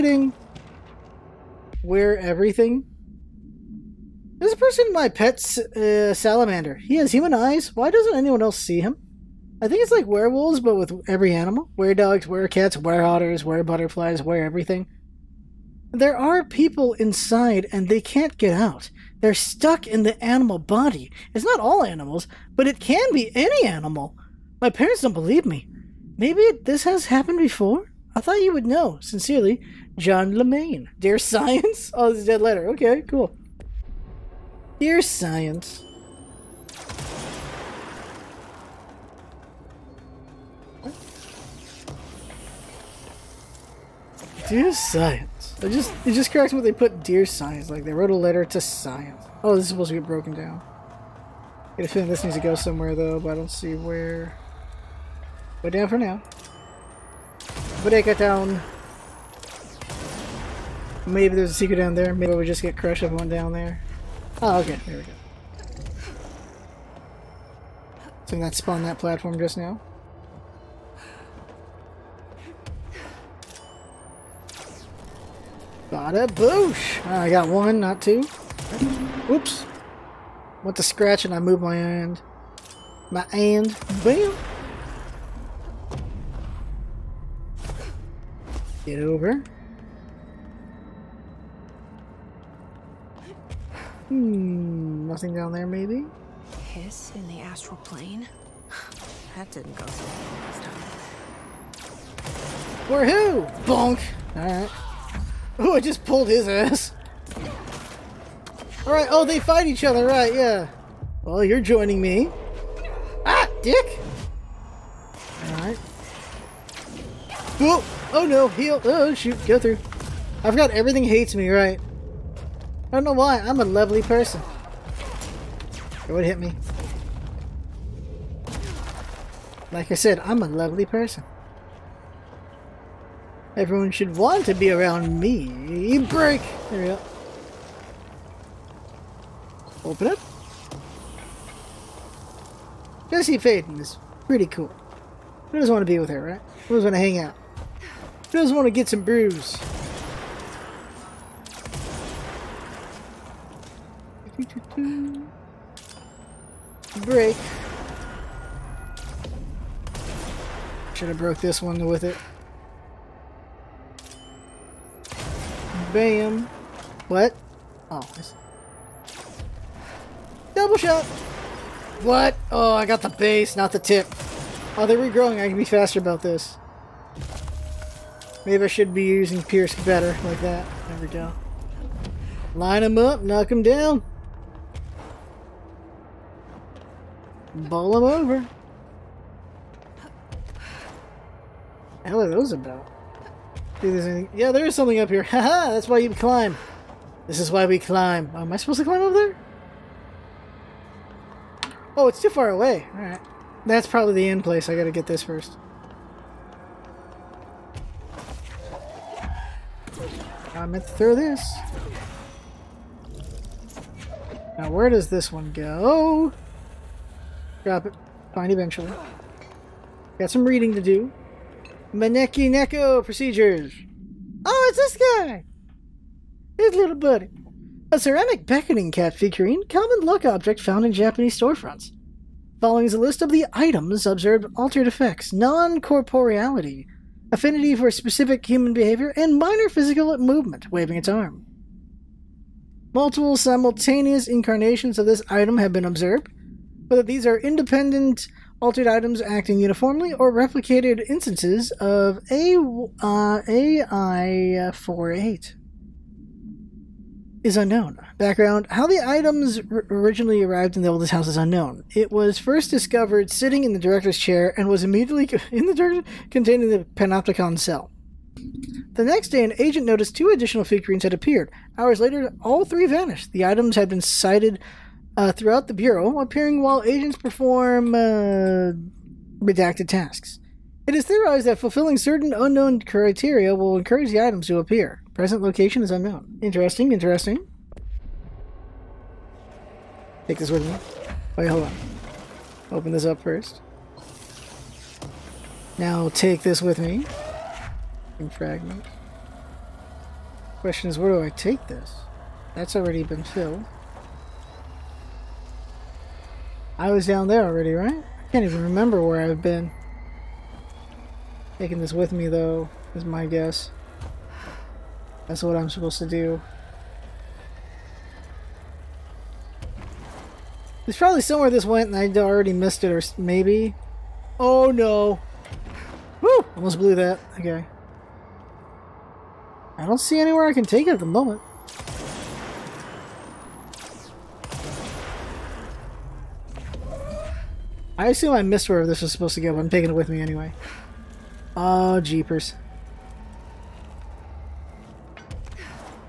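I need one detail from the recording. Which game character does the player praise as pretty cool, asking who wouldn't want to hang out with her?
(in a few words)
Jesse Faden.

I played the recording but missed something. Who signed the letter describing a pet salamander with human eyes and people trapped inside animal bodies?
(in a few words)
John Lemaine.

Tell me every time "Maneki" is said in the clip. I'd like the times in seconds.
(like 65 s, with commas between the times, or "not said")
221 s.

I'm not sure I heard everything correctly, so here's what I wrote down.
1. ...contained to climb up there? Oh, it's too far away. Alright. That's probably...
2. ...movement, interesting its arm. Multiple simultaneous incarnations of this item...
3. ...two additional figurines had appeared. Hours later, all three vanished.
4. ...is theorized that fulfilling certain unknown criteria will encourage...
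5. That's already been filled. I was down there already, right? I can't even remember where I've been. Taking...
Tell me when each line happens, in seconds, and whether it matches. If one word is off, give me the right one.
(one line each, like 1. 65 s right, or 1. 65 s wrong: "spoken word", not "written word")
1. 198 s wrong: "supposed", not "contained"
2. 240 s wrong: "waving", not "interesting"
3. 270 s right
4. 280 s right
5. 302 s right.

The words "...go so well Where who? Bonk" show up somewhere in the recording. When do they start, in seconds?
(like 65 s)
99 s.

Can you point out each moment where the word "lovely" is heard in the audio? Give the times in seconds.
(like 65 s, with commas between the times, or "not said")
123 s, 130 s.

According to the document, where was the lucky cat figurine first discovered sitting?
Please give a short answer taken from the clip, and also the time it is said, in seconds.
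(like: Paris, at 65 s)
The director's chair, at 263 s.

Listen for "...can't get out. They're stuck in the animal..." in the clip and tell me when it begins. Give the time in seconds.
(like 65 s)
18 s.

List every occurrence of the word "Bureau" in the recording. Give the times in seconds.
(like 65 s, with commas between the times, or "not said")
275 s.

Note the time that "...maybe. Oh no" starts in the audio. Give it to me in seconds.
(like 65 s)
323 s.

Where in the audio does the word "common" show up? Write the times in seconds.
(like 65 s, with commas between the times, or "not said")
229 s.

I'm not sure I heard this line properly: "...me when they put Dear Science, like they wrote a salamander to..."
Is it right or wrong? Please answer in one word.
wrong.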